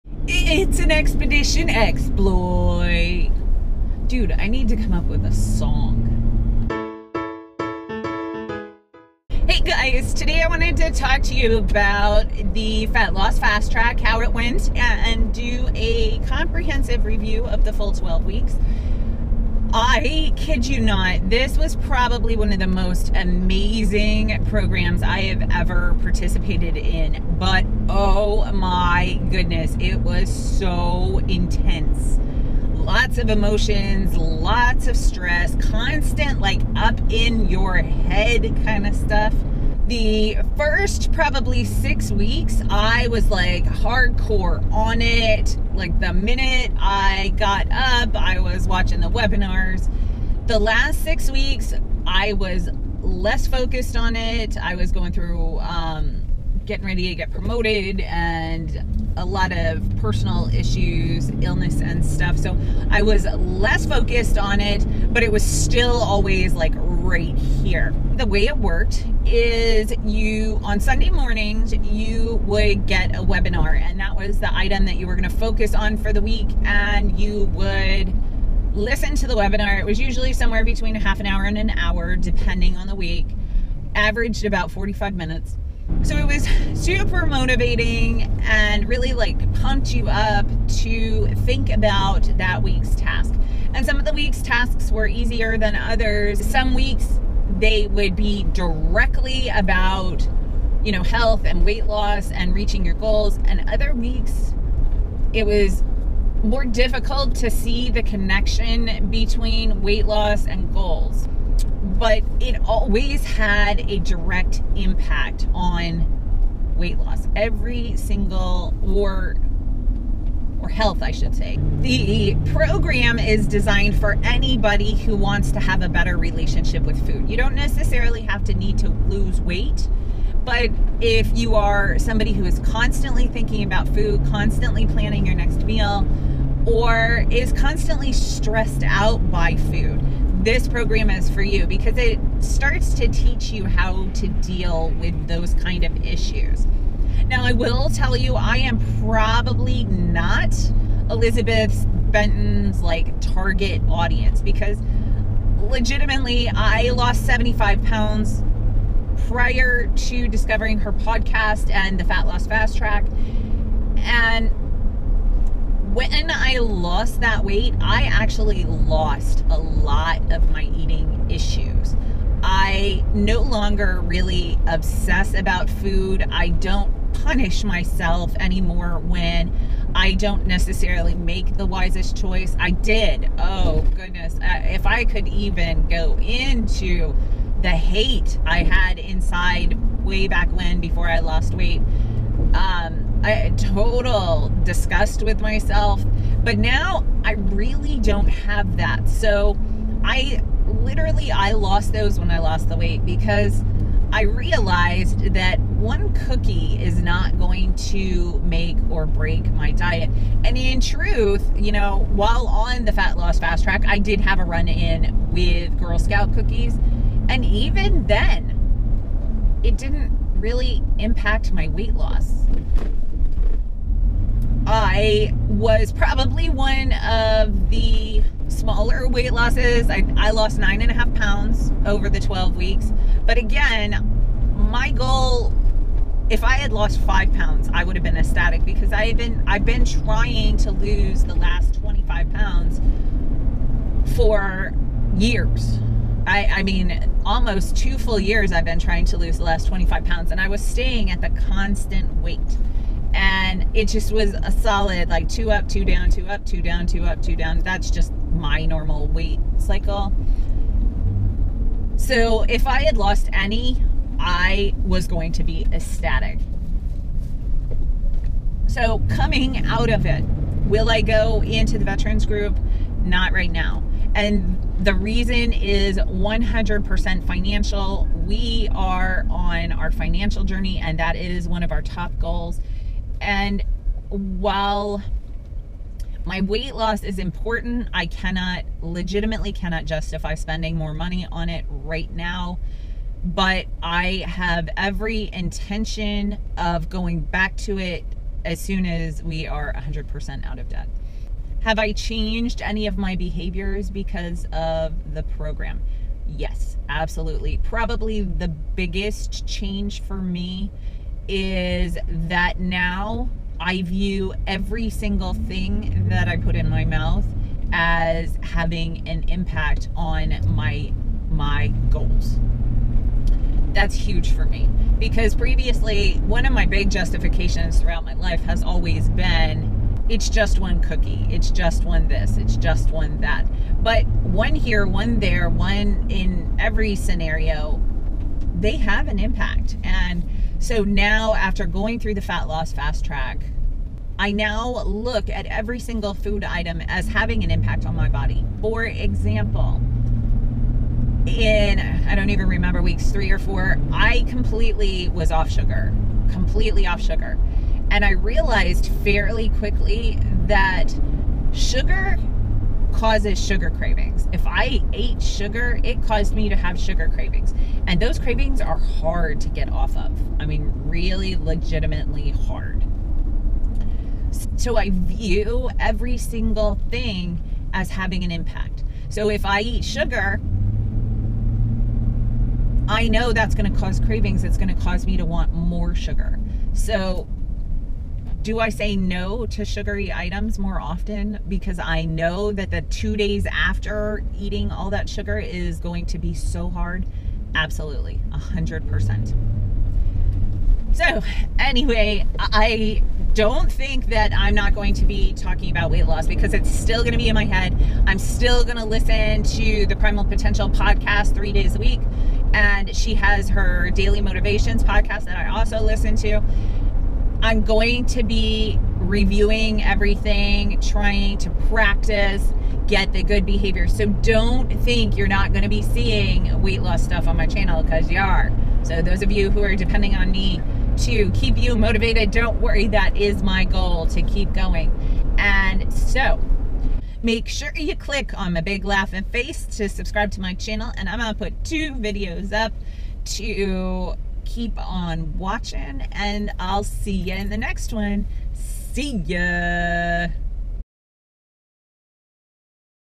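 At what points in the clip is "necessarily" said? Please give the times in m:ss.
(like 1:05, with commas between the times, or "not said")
2:07, 3:00.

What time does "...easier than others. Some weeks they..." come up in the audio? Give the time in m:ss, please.
1:35.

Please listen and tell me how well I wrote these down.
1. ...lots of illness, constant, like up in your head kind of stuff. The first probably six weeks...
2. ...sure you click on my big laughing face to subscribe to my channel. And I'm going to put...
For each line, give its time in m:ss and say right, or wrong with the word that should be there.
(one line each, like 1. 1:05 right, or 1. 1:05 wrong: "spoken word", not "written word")
1. 0:34 wrong: "stress", not "illness"
2. 7:17 right.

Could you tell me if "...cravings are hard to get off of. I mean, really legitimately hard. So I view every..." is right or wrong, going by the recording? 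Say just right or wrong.
right.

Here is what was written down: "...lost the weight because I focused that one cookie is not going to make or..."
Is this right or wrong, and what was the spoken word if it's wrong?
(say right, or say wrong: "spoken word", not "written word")
wrong: "realized", not "focused".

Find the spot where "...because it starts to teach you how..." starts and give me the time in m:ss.
2:21.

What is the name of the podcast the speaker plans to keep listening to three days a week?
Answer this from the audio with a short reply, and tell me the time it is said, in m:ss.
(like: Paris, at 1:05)
Primal Potential, at 6:49.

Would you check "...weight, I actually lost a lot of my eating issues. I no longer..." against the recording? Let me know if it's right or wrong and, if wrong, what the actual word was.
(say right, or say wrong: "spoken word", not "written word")
right.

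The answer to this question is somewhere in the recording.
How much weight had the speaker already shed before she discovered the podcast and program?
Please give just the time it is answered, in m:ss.
2:37.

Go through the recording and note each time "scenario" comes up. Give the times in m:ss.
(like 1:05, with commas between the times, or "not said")
5:36.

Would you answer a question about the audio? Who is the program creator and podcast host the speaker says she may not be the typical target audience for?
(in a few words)
Elizabeth Benton.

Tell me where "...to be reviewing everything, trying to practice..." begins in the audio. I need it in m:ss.
6:58.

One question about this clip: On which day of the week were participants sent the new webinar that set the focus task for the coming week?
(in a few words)
Sunday.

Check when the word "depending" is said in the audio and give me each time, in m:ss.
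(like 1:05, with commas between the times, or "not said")
1:22, 7:09.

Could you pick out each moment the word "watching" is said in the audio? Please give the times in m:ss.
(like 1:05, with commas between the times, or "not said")
0:48, 7:25.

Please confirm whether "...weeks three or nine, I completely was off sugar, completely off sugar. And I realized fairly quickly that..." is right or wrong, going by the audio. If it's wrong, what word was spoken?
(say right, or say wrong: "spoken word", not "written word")
wrong: "four", not "nine".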